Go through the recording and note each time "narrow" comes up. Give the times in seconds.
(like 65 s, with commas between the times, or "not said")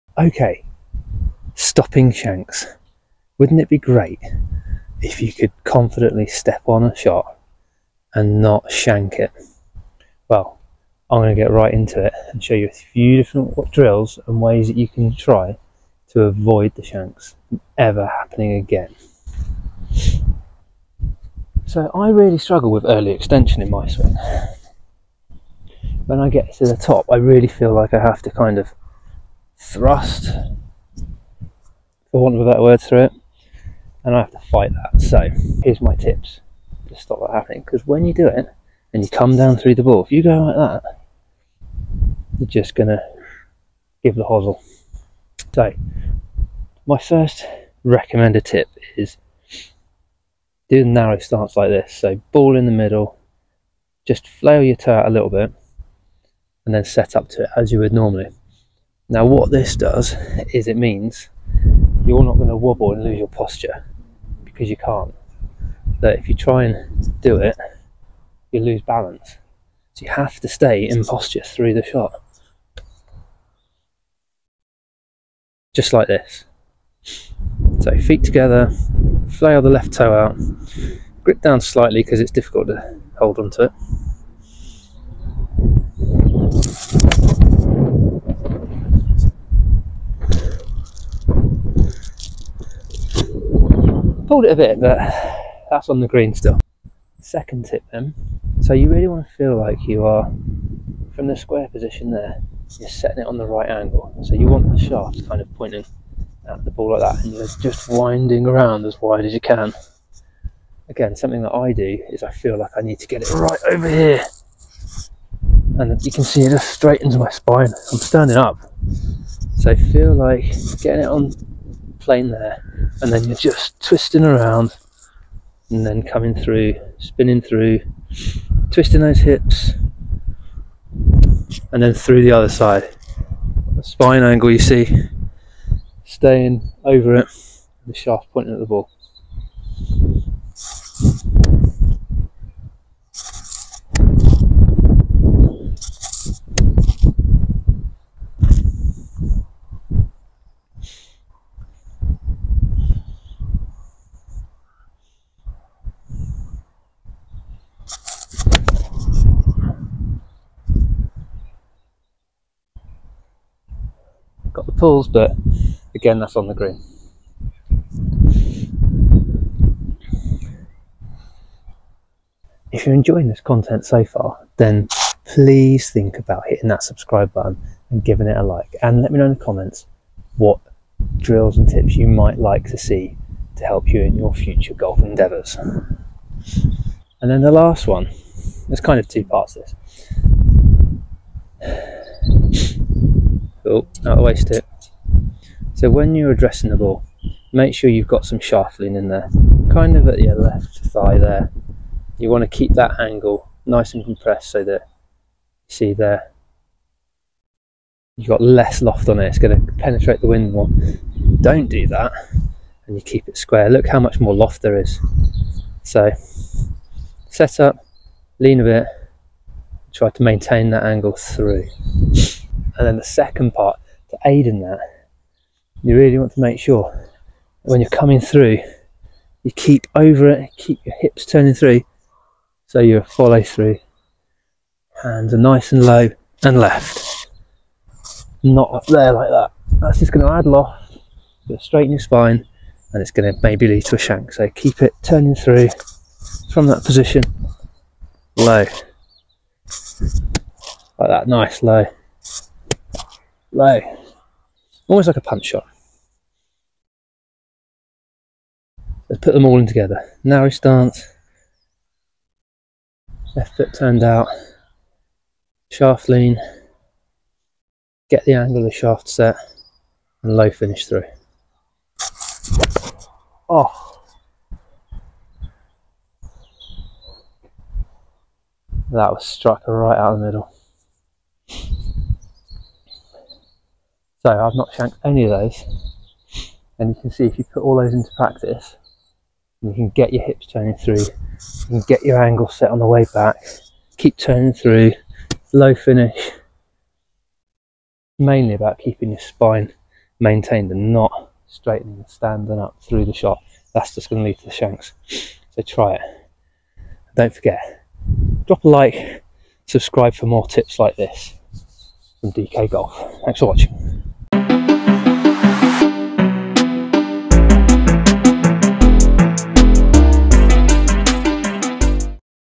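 50 s, 260 s.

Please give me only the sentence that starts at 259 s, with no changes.
Let's put them all in together.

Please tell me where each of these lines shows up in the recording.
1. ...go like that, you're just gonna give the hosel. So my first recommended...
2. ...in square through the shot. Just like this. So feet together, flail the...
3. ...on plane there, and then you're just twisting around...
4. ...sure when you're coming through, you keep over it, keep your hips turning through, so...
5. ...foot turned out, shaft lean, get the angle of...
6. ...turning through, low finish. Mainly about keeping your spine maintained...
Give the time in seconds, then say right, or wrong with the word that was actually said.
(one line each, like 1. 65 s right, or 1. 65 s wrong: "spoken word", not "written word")
1. 40 s right
2. 70 s wrong: "posture", not "square"
3. 121 s right
4. 226 s right
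5. 263 s right
6. 294 s right.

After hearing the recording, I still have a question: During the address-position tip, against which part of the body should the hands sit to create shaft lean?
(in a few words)
Left thigh.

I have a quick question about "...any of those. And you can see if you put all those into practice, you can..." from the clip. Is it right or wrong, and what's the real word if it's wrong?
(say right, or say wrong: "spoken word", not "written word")
right.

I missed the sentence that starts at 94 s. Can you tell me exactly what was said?
pulled it a bit, but that's on the green still.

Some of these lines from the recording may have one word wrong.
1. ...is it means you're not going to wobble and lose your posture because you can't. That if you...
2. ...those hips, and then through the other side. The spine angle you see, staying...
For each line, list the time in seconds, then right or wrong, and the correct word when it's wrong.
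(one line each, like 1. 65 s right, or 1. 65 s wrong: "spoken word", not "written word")
1. 60 s right
2. 128 s right.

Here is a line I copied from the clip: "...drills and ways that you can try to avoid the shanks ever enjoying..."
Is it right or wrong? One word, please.
wrong.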